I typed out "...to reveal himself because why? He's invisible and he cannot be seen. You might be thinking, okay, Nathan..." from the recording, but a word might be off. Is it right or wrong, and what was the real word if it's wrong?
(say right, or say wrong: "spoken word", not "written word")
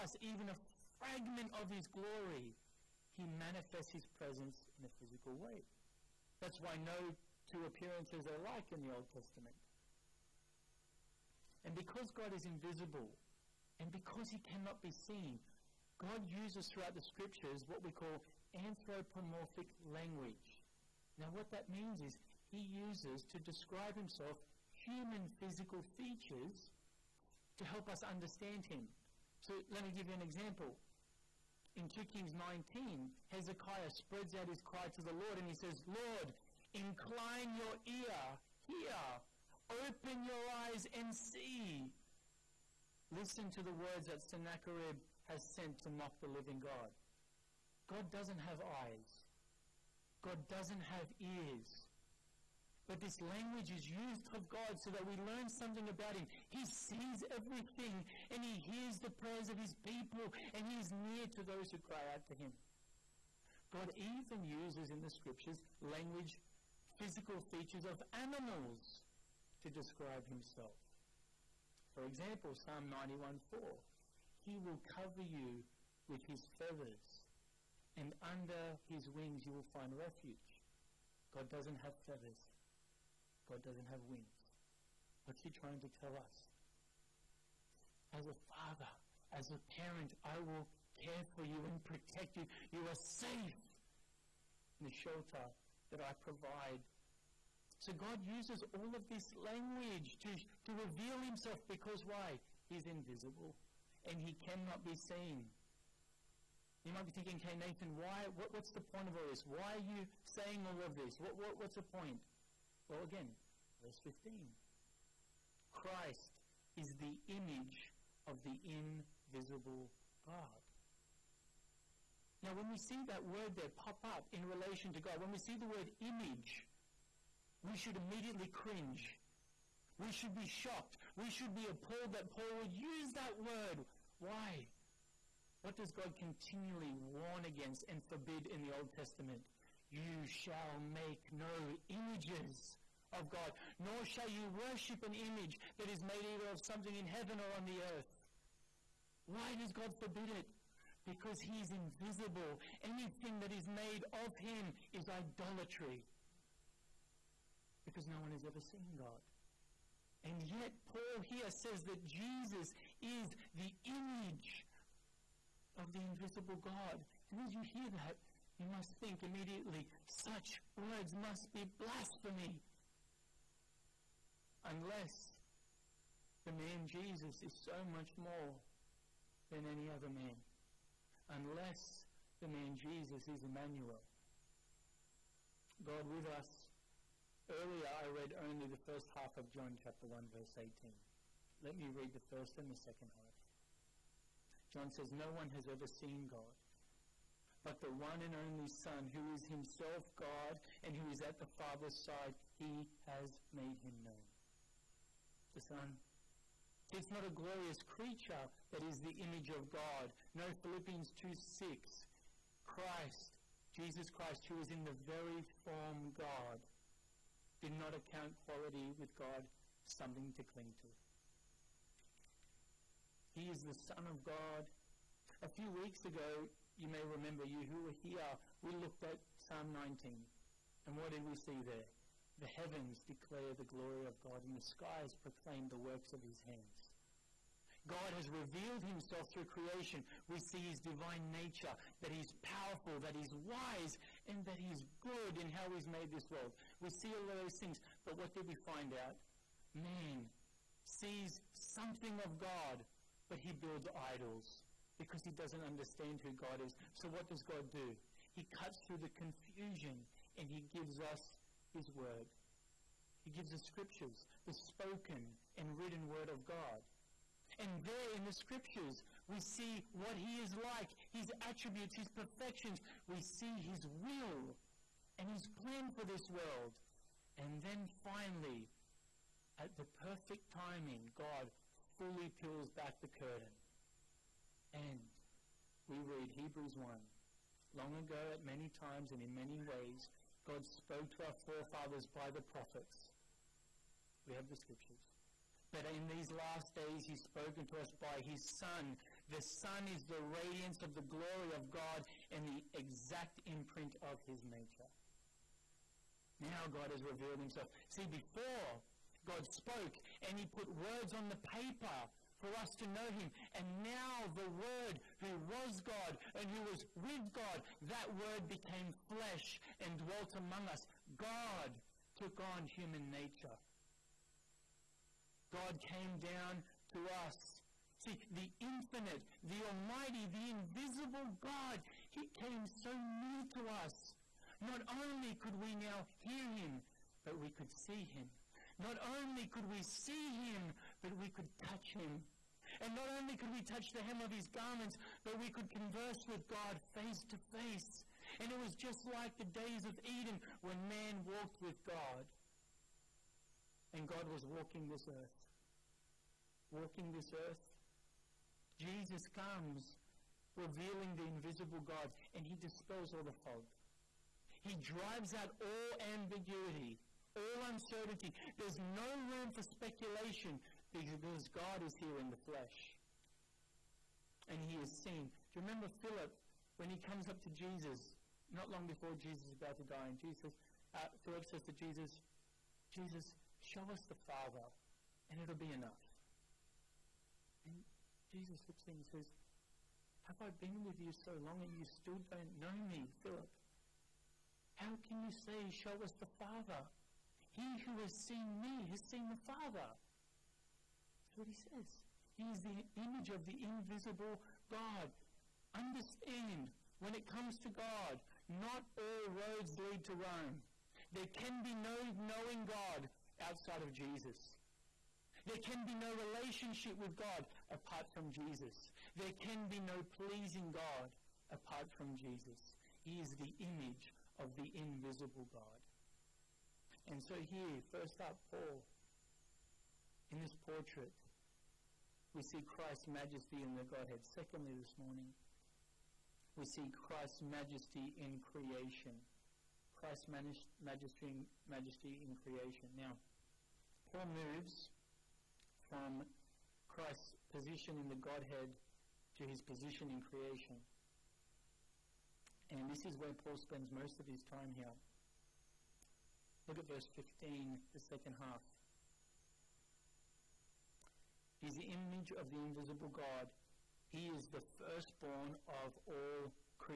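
right.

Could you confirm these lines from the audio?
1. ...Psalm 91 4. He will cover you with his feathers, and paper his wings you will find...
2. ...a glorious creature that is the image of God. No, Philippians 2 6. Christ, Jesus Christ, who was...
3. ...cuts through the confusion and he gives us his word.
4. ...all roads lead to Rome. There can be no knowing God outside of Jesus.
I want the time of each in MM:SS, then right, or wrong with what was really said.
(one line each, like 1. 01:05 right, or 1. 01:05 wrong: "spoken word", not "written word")
1. 01:12 wrong: "under", not "paper"
2. 03:27 right
3. 04:18 right
4. 06:48 right.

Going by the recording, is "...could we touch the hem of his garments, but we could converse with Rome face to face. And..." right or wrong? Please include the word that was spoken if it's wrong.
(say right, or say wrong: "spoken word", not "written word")
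wrong: "God", not "Rome".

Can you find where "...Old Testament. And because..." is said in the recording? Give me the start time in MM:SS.
00:08.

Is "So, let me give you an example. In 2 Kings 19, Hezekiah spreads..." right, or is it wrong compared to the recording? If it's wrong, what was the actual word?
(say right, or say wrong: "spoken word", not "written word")
right.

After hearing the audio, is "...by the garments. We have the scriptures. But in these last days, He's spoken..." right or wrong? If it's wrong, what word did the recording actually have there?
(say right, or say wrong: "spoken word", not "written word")
wrong: "prophets", not "garments".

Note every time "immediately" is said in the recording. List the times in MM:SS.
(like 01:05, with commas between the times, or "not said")
02:07, 02:49.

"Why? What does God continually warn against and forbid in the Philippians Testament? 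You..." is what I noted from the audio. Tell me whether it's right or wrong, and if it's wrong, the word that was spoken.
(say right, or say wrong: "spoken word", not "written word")
wrong: "Old", not "Philippians".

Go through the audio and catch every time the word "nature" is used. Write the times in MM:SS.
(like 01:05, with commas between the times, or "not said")
04:01, 05:04, 05:23.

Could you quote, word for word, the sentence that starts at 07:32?
And this is where Paul spends most of his time here.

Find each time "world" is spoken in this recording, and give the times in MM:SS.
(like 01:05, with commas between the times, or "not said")
04:06, 04:36.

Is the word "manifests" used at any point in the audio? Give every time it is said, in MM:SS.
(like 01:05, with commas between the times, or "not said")
00:03.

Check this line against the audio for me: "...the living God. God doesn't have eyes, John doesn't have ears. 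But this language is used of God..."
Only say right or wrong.
wrong.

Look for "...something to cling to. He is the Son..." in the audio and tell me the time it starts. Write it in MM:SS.
03:39.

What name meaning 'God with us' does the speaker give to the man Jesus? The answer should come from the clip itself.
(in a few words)
Emmanuel.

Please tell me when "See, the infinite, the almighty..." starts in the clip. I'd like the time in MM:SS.
05:28.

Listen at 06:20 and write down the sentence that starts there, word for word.
And Jesus, uh, Philip says to Jesus, Jesus, show us the Father, and it'll be enough.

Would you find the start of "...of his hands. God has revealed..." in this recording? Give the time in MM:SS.
03:56.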